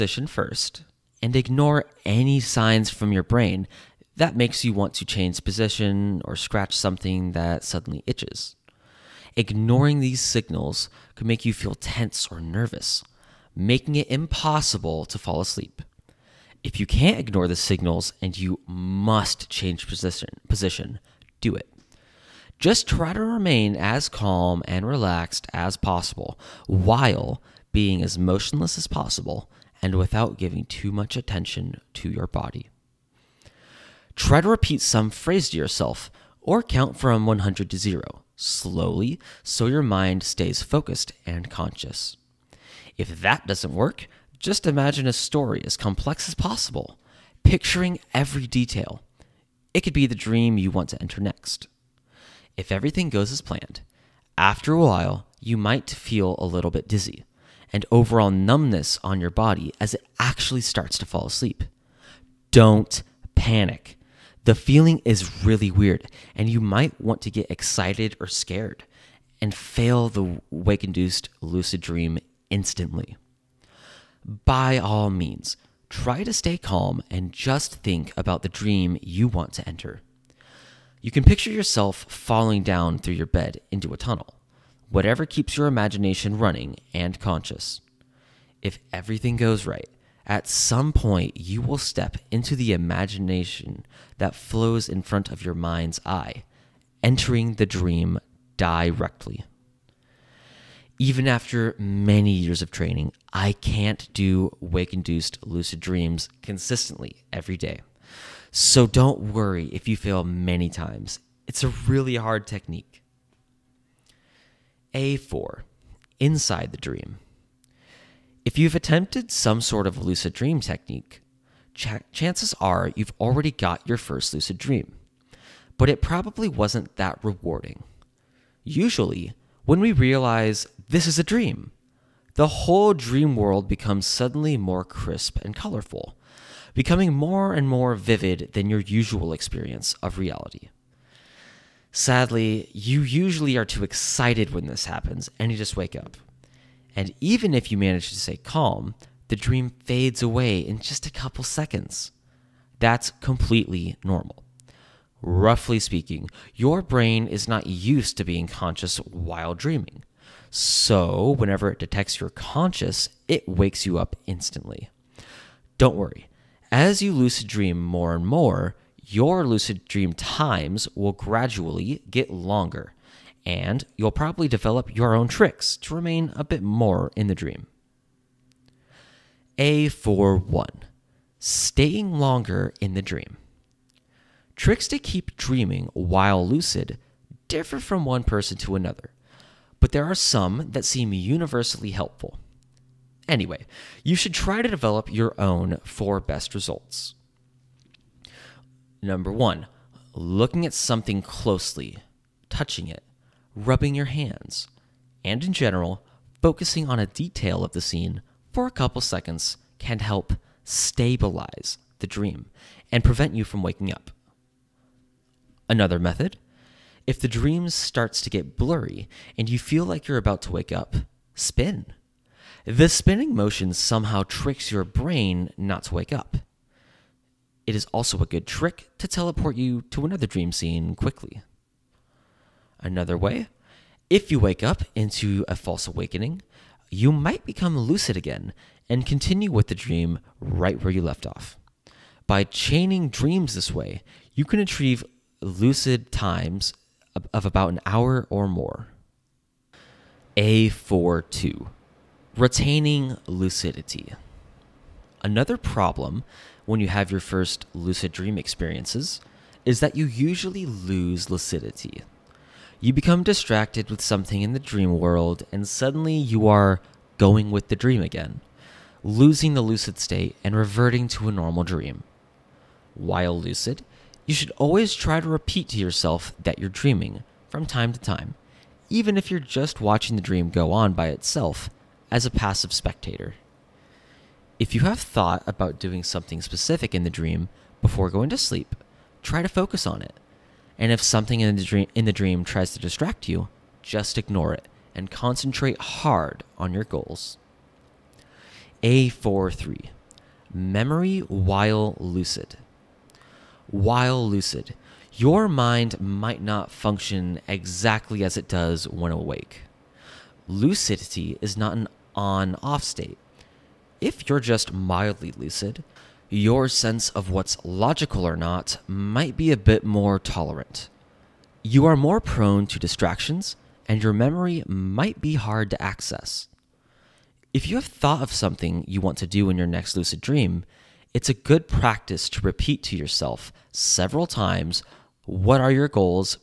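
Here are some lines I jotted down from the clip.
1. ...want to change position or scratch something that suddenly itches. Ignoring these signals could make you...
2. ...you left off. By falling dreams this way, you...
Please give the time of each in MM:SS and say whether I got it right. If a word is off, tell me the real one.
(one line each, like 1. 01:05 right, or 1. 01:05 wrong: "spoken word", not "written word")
1. 00:04 right
2. 04:00 wrong: "chaining", not "falling".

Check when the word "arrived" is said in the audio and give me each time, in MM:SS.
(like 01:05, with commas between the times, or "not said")
not said.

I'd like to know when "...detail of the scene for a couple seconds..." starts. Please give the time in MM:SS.
03:27.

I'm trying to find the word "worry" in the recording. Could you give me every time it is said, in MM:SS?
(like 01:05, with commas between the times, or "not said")
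01:49, 02:45.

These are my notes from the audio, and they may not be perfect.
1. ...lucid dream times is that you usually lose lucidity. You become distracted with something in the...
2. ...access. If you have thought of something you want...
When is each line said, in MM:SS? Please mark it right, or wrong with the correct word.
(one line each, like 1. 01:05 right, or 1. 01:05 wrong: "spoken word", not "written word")
1. 04:17 wrong: "experiences", not "times"
2. 05:25 right.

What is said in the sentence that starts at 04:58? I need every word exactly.
A43 Memory while lucid while lucid, your mind might not function exactly as it does when awake.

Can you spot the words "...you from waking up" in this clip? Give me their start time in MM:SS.
03:33.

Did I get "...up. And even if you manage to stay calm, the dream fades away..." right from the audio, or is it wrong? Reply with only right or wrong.
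right.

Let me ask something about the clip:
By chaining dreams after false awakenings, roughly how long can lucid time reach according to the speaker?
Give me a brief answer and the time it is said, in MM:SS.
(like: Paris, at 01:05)
About an hour, at 04:07.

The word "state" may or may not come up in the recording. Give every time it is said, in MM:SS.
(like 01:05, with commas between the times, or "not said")
04:29, 05:12.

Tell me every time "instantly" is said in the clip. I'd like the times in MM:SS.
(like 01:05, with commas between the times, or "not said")
01:12, 02:44.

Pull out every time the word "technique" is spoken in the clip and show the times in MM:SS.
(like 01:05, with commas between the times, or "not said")
01:52, 02:00.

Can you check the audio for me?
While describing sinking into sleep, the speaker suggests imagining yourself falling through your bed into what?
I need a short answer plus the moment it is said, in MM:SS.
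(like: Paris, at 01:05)
A tunnel, at 01:23.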